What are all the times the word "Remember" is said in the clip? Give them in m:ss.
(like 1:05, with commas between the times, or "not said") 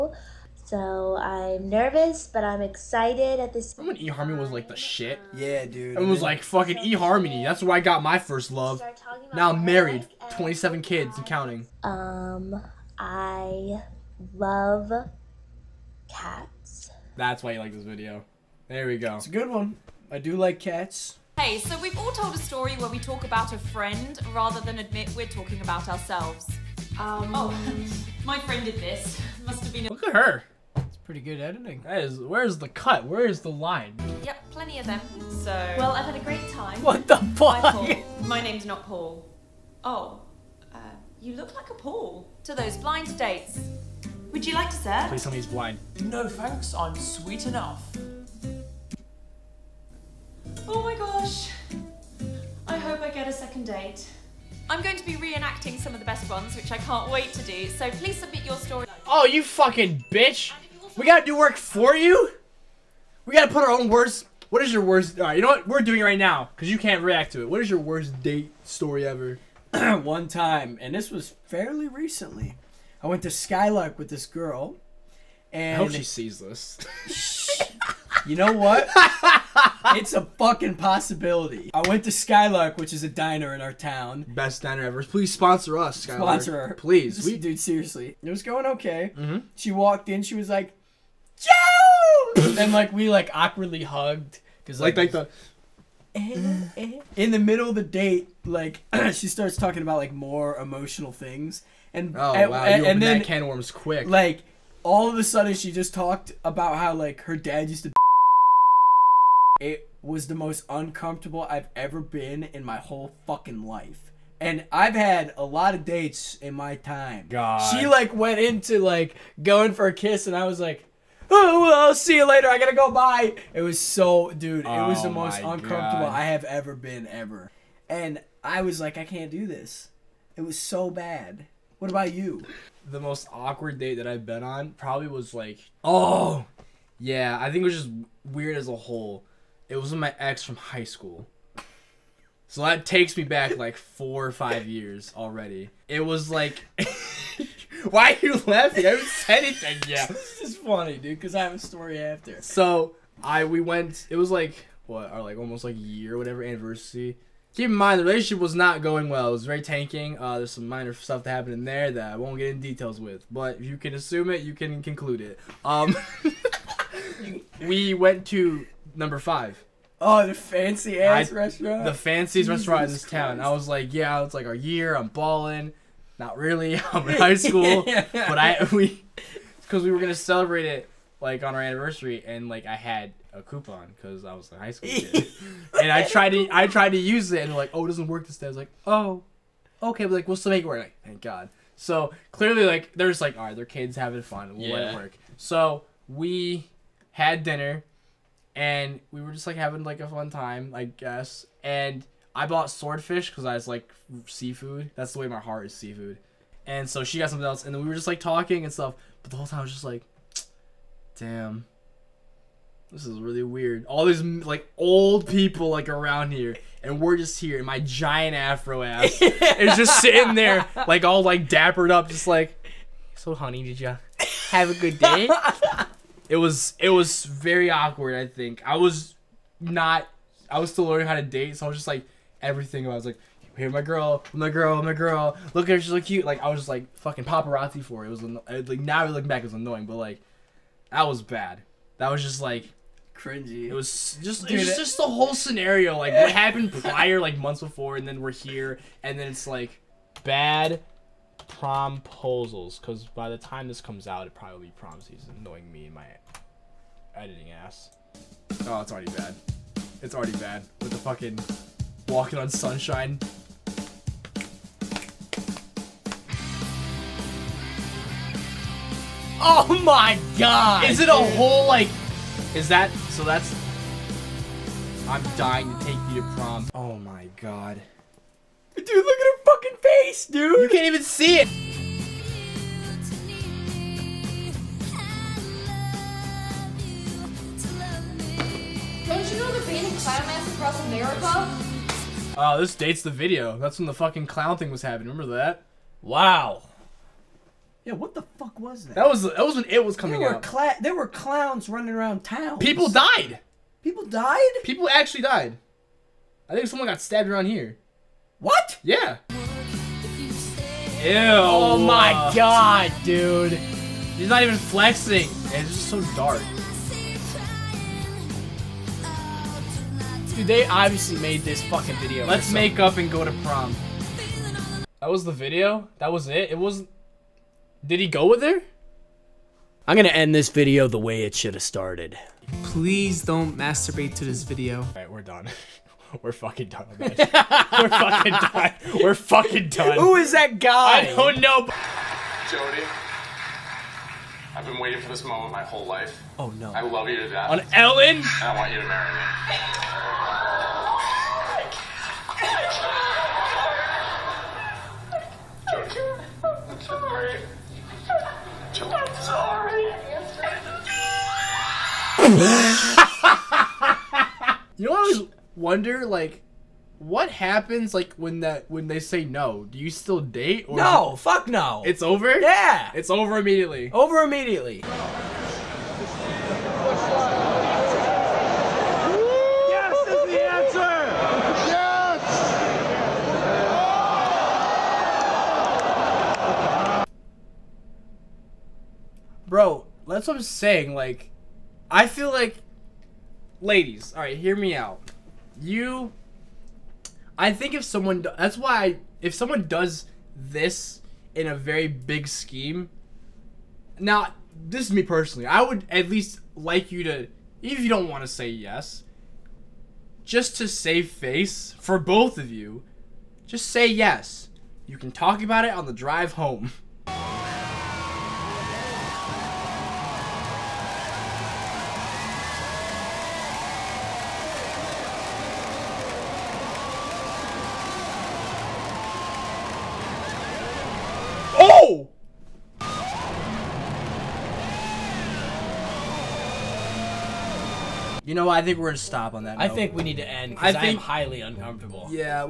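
0:03, 4:55.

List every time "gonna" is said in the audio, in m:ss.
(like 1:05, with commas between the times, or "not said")
2:59, 5:29, 7:18.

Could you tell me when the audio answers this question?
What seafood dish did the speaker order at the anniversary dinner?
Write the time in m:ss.
3:22.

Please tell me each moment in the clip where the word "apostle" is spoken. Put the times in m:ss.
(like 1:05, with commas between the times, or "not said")
not said.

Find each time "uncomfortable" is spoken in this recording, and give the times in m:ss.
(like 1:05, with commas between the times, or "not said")
1:50, 2:05, 7:21.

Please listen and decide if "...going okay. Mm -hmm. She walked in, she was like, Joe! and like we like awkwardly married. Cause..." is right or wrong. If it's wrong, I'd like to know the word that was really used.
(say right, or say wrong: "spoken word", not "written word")
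wrong: "hugged", not "married".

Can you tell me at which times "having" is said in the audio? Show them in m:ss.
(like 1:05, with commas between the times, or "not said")
3:13, 3:19.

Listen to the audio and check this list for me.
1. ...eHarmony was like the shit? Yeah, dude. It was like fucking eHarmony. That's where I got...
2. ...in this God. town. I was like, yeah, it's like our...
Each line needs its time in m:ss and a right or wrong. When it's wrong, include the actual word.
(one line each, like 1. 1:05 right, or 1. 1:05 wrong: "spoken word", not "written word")
1. 0:04 right
2. 2:52 wrong: "Christ", not "God".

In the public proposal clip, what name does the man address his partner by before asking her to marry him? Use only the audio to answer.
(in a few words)
Jody.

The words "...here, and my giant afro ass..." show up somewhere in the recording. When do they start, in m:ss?
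3:37.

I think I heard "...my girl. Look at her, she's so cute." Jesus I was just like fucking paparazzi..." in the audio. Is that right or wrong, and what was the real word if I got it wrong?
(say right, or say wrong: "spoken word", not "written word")
wrong: "Like", not "Jesus".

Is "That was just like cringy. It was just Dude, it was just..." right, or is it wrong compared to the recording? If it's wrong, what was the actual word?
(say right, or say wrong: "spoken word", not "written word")
right.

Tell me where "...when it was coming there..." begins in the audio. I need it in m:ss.
4:59.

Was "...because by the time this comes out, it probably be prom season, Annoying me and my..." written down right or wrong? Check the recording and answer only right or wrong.
right.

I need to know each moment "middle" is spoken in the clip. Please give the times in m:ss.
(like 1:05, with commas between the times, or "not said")
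1:37.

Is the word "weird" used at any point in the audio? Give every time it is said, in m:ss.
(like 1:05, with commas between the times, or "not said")
2:18, 3:33.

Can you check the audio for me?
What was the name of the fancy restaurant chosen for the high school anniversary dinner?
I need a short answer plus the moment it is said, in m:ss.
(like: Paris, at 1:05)
Number Five, at 2:48.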